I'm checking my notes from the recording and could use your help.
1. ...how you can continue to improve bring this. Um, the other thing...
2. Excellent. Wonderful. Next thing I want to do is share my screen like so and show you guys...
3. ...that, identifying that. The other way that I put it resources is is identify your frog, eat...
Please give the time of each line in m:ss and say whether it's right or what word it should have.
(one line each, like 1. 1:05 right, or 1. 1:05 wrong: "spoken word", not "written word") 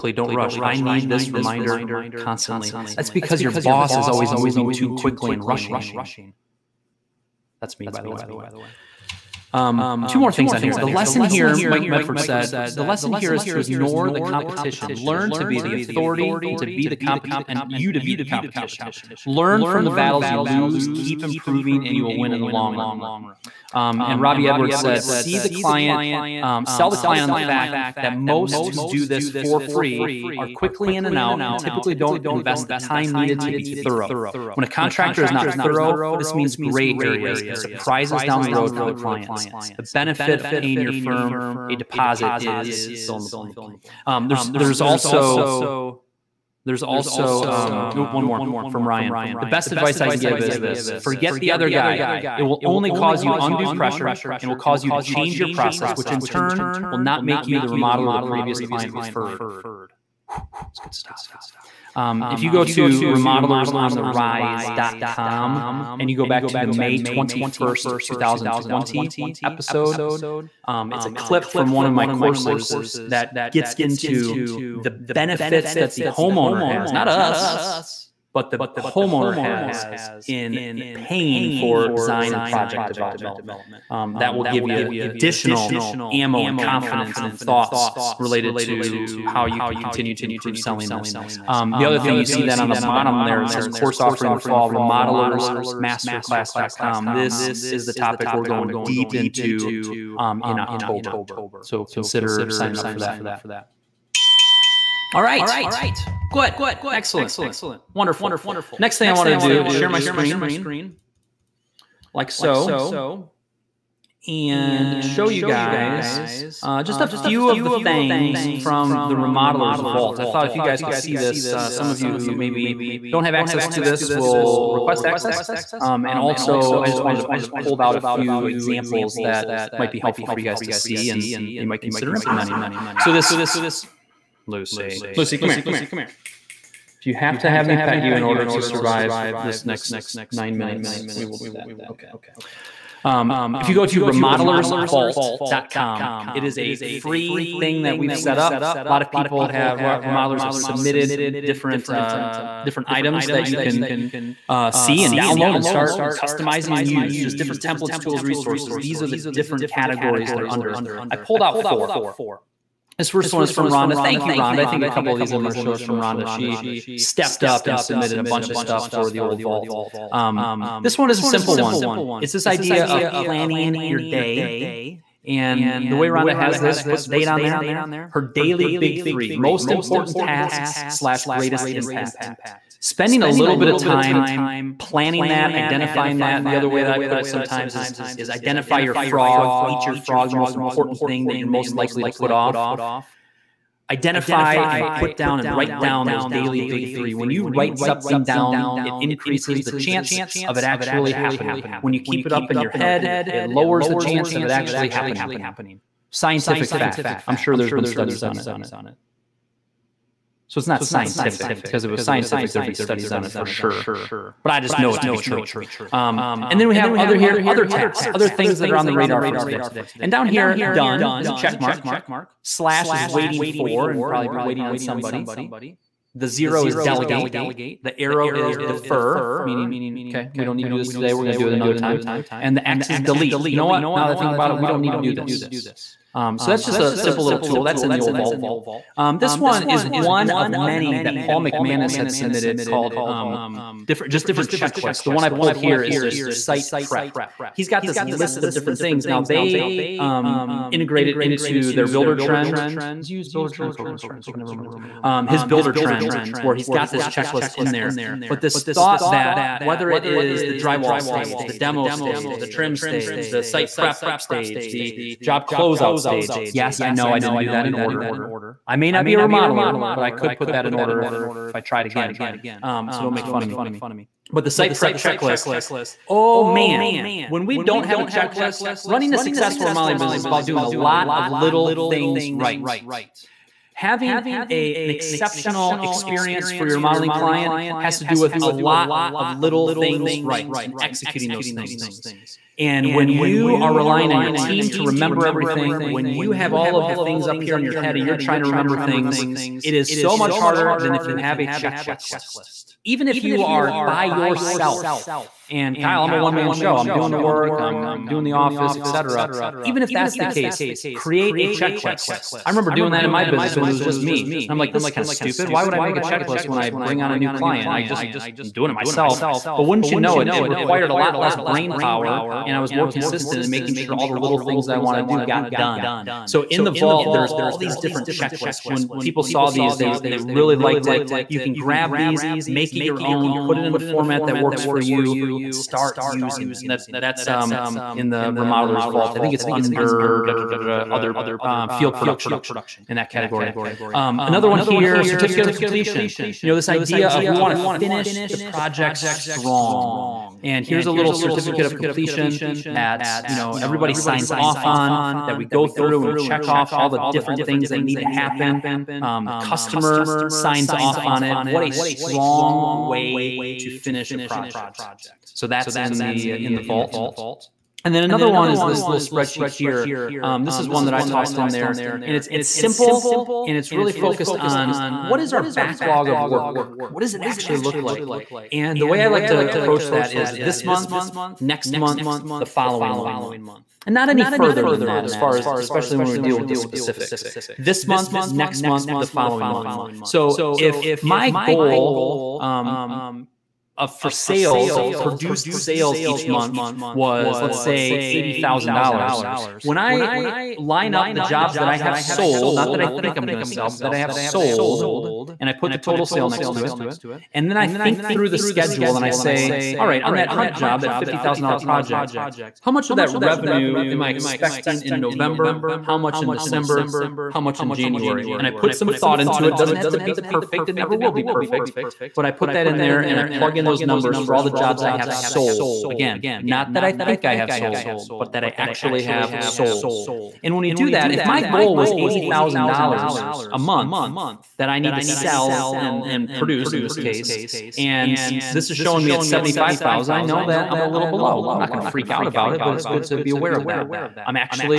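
1. 1:29 wrong: "selling", not "bring"
2. 1:46 right
3. 3:05 wrong: "sometimes", not "resources".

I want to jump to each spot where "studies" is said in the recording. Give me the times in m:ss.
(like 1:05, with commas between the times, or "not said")
3:27, 3:32.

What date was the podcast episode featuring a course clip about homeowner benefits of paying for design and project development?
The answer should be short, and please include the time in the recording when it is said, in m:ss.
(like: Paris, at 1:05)
May 21st, 2020, at 1:06.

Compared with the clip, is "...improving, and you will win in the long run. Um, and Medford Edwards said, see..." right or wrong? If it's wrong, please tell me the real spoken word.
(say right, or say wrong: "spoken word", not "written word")
wrong: "Robbie", not "Medford".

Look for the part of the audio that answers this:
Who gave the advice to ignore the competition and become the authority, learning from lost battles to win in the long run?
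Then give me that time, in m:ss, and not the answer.
0:11.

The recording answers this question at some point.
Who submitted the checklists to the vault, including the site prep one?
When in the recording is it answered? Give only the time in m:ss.
4:01.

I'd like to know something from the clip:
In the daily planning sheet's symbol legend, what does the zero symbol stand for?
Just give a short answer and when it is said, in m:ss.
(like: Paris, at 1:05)
Delegate, at 3:46.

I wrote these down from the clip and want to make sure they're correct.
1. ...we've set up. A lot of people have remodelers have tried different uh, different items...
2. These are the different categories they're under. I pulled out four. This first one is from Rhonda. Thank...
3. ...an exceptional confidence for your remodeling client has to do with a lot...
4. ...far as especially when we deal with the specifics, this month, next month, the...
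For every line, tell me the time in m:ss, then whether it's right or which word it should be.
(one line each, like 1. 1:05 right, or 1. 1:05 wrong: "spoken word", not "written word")
1. 2:27 wrong: "submitted", not "tried"
2. 2:38 right
3. 4:44 wrong: "experience", not "confidence"
4. 6:25 right.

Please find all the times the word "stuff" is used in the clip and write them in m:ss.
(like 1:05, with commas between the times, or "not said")
1:00, 2:48.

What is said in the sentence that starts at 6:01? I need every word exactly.
What a strong way to finish a project.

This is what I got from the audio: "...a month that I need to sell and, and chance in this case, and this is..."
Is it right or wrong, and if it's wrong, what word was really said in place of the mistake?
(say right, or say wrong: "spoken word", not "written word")
wrong: "produce", not "chance".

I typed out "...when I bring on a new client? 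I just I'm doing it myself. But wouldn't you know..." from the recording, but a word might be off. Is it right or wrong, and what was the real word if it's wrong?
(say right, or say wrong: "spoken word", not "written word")
right.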